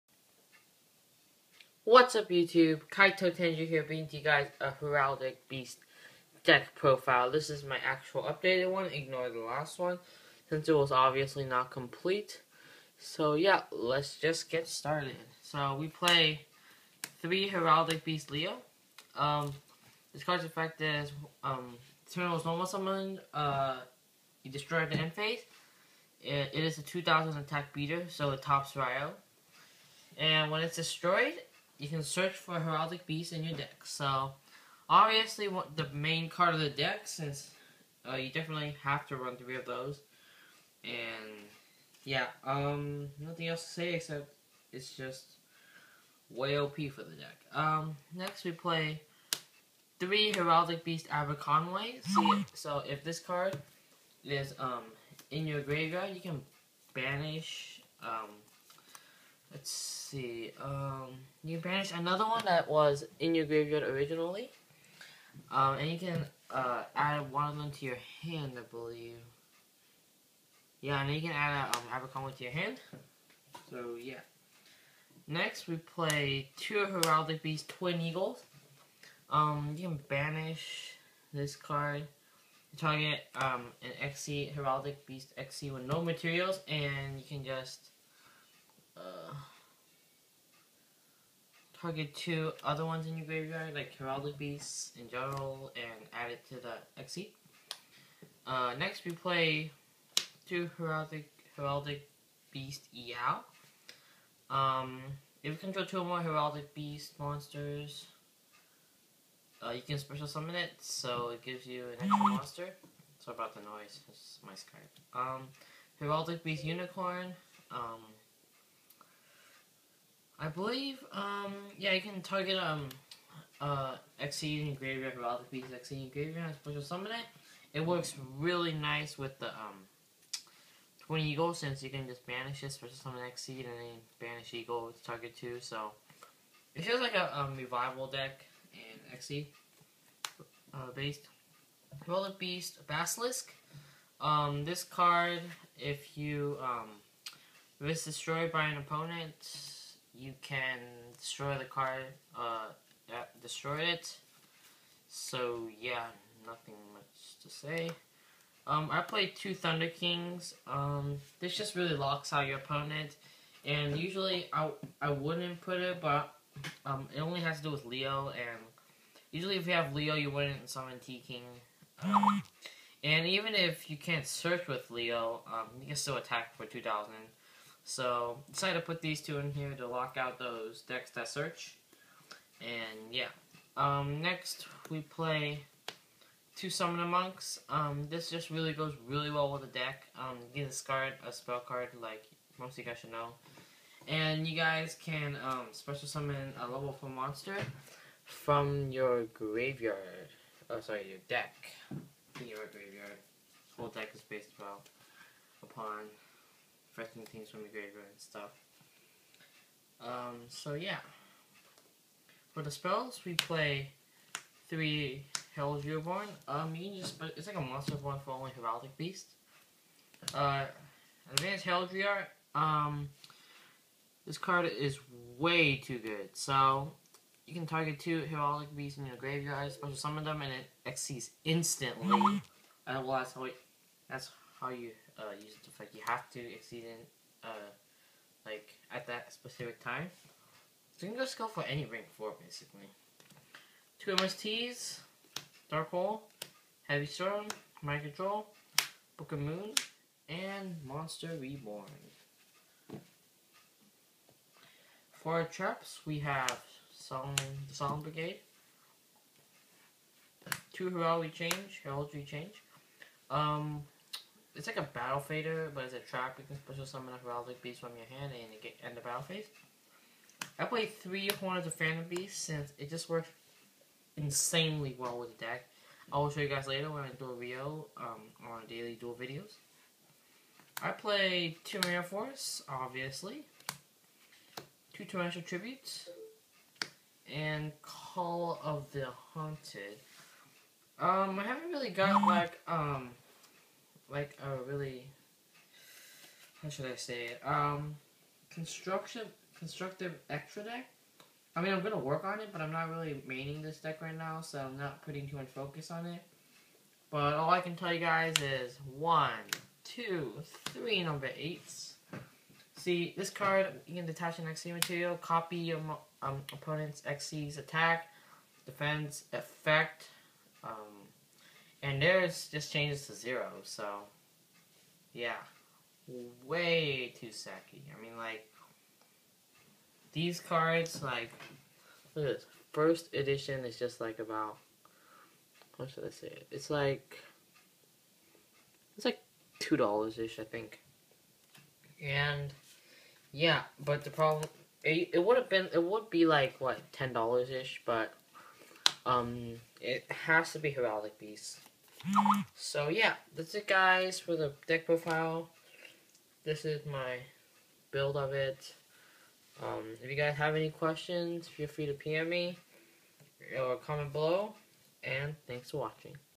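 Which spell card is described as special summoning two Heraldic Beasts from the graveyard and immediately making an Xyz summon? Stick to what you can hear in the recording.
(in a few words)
Advanced Heraldry Art.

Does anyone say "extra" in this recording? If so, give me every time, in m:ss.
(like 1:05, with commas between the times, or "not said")
1:52, 5:00.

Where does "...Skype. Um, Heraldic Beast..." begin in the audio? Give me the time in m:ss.
1:54.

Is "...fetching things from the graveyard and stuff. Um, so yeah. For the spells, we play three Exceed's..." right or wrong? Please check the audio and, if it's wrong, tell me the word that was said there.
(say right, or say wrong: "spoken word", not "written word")
wrong: "Hell", not "Exceed".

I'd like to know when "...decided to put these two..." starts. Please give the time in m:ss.
2:58.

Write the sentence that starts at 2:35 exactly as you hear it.
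So yeah, nothing much to say.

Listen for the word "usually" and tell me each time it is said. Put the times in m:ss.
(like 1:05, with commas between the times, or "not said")
2:43, 2:49.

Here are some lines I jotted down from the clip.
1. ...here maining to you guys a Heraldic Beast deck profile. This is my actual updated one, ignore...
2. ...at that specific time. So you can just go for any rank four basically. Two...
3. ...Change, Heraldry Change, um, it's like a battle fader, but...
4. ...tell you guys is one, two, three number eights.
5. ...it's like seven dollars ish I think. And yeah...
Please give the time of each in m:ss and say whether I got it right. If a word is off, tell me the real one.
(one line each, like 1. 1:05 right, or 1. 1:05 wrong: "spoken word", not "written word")
1. 0:03 wrong: "bringing", not "maining"
2. 3:58 right
3. 4:21 right
4. 5:07 right
5. 5:38 wrong: "two", not "seven".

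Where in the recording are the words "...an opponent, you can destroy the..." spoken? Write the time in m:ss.
2:28.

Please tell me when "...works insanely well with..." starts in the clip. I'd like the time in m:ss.
4:33.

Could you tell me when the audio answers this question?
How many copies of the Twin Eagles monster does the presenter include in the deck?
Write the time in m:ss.
1:16.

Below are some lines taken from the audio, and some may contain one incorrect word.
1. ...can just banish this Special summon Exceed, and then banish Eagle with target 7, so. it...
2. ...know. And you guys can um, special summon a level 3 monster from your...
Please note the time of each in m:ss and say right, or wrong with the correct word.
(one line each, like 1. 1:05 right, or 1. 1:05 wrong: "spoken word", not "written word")
1. 2:11 wrong: "2", not "7"
2. 3:13 wrong: "4", not "3".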